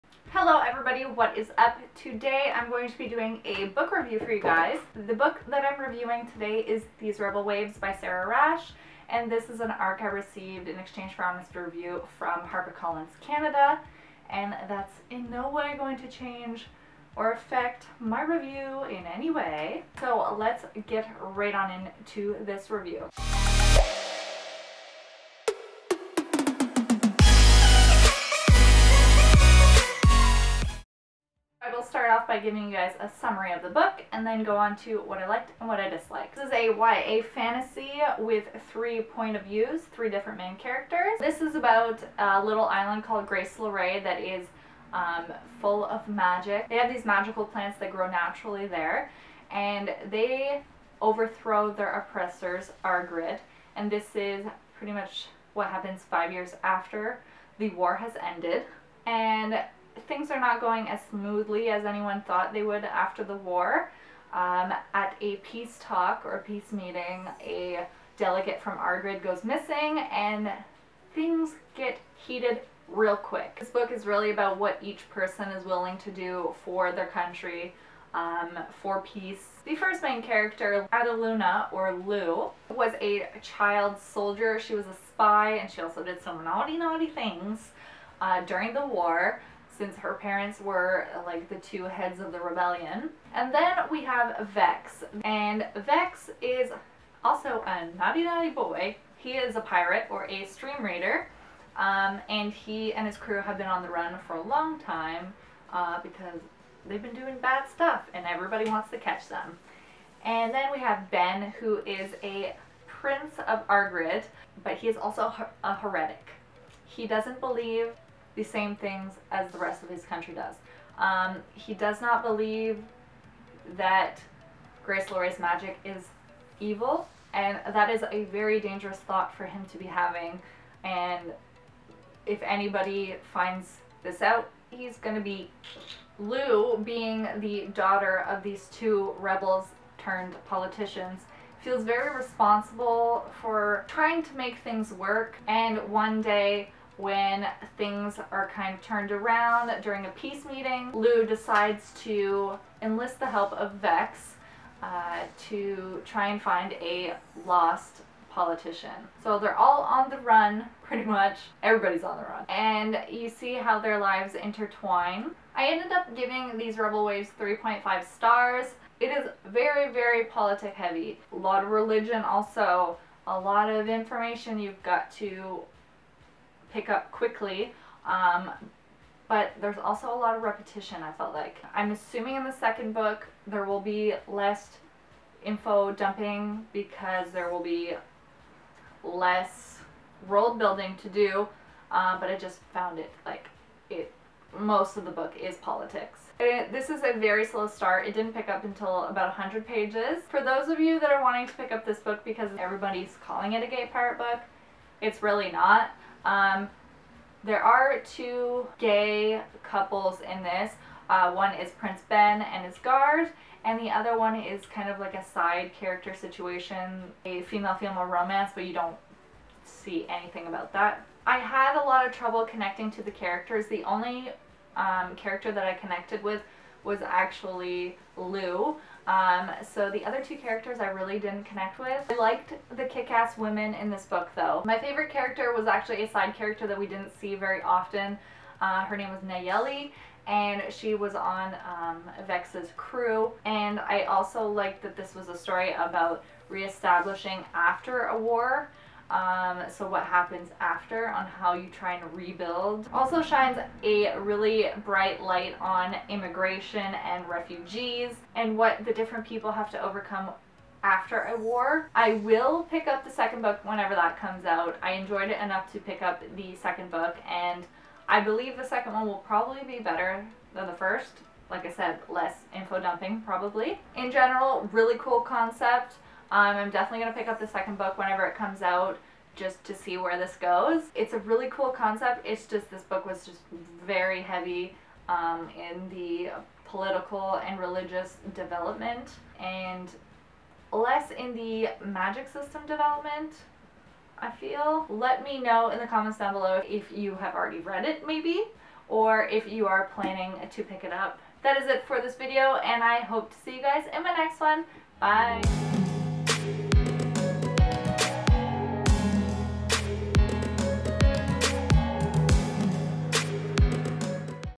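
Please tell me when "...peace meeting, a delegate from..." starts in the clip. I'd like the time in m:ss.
1:06.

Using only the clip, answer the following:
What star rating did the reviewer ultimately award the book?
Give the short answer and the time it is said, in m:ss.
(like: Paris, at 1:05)
3.5, at 2:47.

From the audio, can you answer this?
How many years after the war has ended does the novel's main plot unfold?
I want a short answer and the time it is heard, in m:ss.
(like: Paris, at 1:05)
5, at 0:56.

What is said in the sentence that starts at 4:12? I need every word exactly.
Also shines a really bright light on immigration and refugees and what the different people have to overcome after a war.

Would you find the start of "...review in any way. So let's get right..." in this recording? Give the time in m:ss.
0:18.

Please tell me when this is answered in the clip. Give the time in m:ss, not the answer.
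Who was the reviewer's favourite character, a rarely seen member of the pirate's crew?
3:59.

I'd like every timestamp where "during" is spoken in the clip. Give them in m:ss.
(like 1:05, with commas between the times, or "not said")
1:28, 2:29.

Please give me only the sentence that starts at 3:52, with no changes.
I liked the kick-ass women in this book though.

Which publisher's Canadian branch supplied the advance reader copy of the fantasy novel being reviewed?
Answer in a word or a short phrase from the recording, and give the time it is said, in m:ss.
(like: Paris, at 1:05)
HarperCollins, at 0:12.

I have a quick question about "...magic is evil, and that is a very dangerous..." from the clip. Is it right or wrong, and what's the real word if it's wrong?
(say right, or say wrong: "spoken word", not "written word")
right.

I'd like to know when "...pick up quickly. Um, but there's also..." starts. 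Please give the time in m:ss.
2:56.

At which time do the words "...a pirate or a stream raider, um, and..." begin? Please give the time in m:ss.
1:39.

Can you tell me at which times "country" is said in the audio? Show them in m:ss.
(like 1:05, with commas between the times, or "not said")
1:17, 2:00.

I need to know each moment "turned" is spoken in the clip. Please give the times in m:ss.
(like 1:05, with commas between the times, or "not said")
2:19, 2:28.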